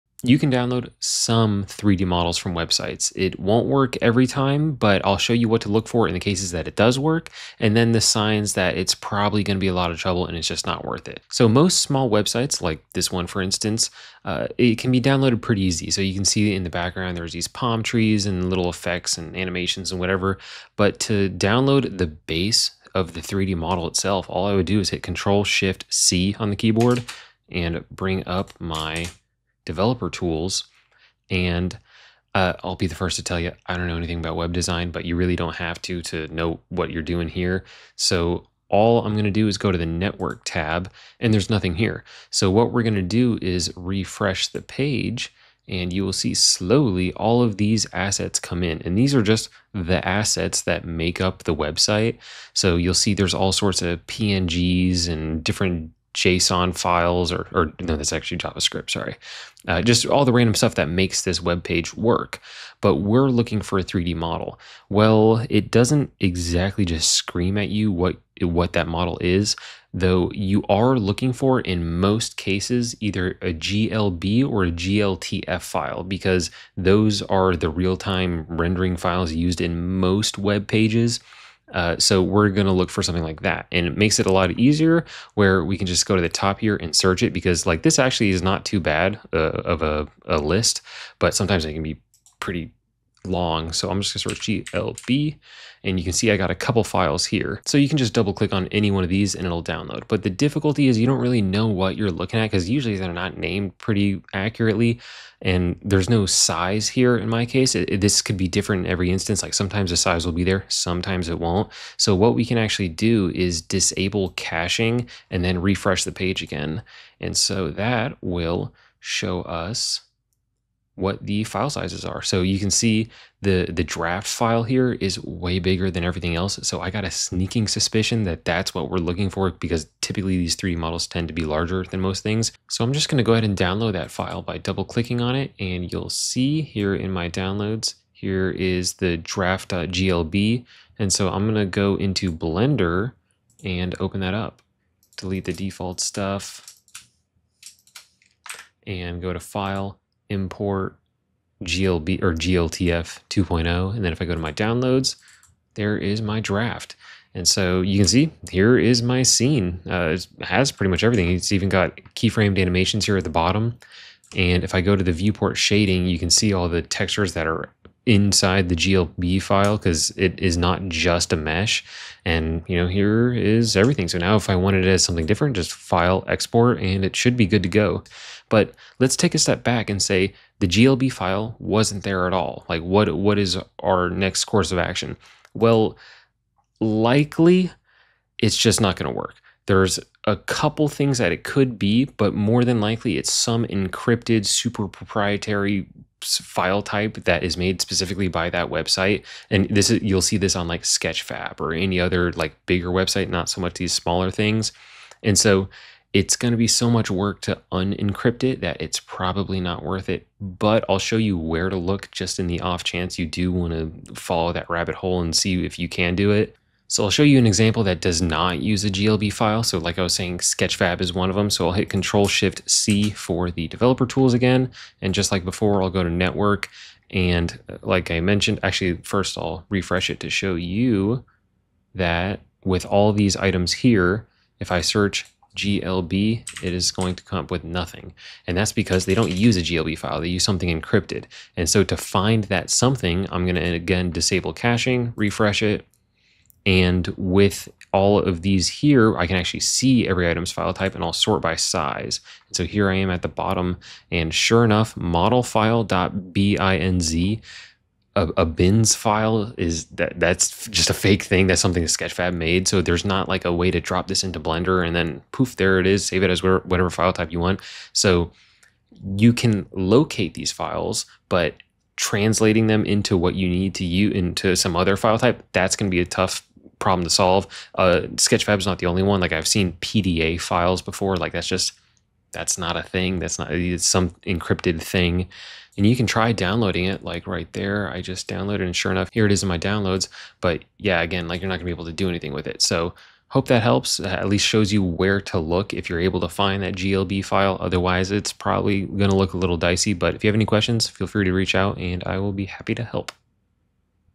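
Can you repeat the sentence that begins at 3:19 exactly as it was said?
And this is you'll see this on like Sketchfab or any other like bigger website, not so much these smaller things.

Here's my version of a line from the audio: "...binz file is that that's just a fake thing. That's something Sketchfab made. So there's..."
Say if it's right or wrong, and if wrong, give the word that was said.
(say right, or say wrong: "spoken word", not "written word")
right.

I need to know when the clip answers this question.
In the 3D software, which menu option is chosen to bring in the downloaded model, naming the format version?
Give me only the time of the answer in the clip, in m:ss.
2:31.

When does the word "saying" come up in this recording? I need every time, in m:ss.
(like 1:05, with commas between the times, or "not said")
3:40.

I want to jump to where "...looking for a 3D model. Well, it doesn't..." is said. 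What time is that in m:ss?
1:03.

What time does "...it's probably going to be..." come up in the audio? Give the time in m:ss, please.
0:08.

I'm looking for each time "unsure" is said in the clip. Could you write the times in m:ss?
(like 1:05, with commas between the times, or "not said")
not said.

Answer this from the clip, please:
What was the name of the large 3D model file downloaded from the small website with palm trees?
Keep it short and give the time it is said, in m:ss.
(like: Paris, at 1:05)
draft.glb, at 2:19.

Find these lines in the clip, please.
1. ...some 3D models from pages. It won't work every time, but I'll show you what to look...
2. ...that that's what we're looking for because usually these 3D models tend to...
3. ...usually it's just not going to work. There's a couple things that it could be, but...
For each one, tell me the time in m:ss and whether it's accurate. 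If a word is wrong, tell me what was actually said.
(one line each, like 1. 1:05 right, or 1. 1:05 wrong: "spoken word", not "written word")
1. 0:00 wrong: "websites", not "pages"
2. 2:08 wrong: "typically", not "usually"
3. 3:06 wrong: "likely", not "usually".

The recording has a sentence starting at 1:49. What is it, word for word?
Like sometimes the size will be there, sometimes it won't.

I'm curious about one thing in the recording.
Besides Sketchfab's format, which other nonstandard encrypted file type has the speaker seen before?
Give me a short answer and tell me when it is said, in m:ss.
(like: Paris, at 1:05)
PDA, at 4:39.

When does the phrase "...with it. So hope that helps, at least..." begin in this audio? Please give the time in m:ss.
4:52.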